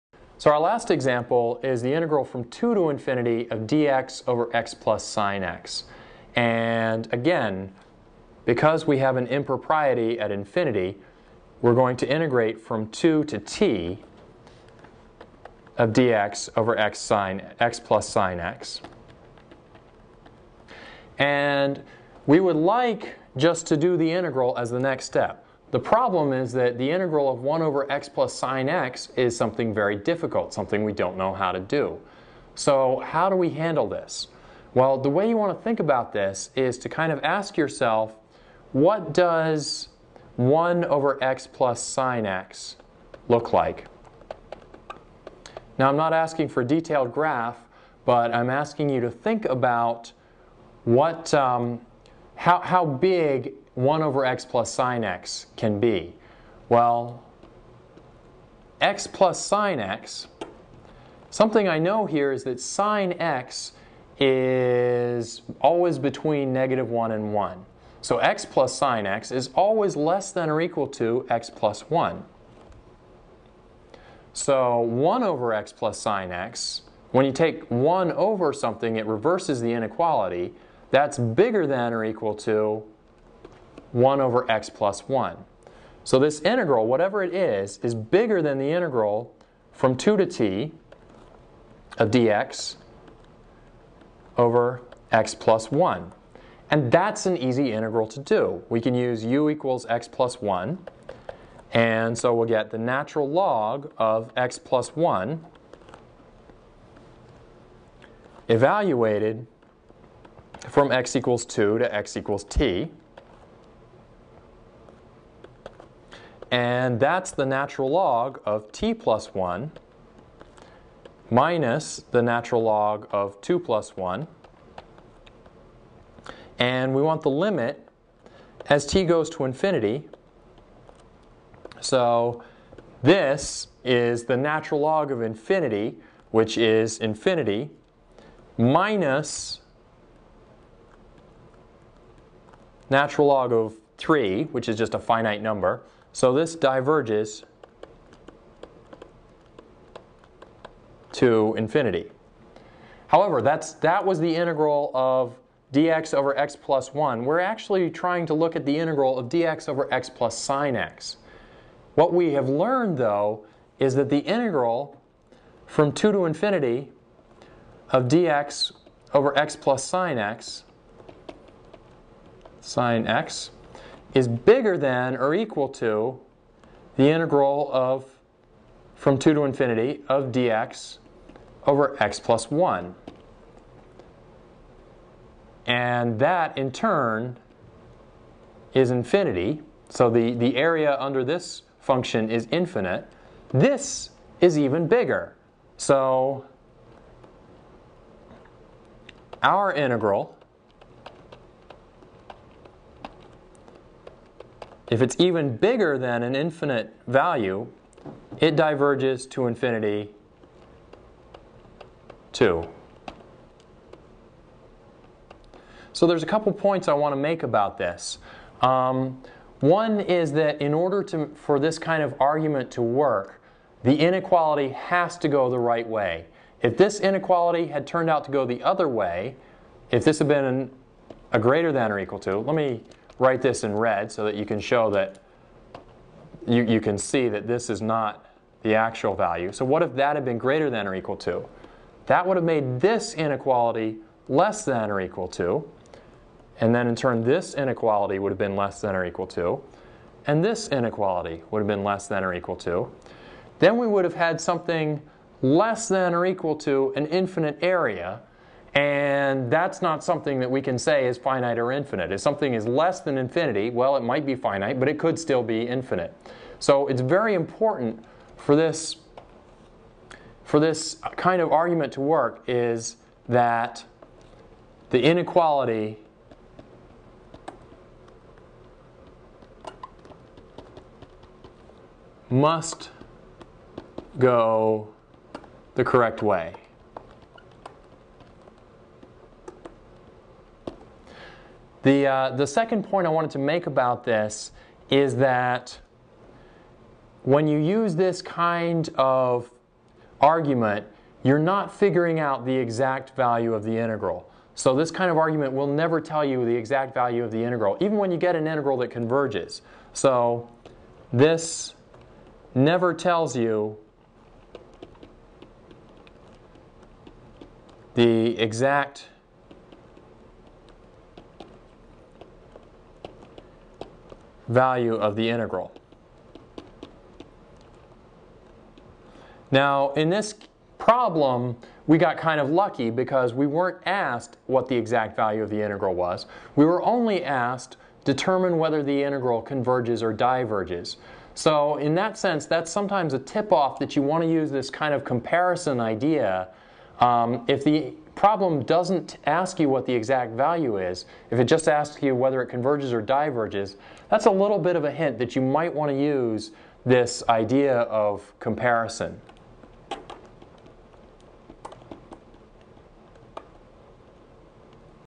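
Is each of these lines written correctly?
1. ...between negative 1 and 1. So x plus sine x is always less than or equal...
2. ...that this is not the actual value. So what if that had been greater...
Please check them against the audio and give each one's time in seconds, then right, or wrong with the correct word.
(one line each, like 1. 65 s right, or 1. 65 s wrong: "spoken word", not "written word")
1. 65 s right
2. 237 s right.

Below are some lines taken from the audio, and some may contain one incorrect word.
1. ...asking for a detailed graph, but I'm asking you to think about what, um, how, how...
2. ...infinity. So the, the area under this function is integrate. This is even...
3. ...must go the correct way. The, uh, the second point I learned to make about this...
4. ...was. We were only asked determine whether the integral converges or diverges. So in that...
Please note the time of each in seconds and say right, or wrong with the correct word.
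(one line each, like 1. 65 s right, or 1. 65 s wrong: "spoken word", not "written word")
1. 46 s right
2. 188 s wrong: "infinite", not "integrate"
3. 282 s wrong: "wanted", not "learned"
4. 335 s right.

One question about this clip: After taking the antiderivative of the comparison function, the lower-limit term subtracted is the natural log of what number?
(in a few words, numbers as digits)
3.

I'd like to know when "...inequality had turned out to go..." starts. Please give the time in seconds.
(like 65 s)
226 s.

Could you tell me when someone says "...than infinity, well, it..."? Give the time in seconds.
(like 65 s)
263 s.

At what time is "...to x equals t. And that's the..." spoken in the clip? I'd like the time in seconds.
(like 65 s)
111 s.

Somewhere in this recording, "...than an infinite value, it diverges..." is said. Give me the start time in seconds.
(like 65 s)
205 s.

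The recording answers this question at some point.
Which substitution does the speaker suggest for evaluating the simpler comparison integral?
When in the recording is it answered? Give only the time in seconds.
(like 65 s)
99 s.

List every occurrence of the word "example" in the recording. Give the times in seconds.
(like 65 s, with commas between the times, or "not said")
0 s.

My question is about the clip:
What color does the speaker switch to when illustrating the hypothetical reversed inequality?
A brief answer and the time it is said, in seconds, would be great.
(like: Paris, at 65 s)
red, at 233 s.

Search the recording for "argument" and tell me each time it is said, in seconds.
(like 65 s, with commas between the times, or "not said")
222 s, 271 s, 300 s, 305 s.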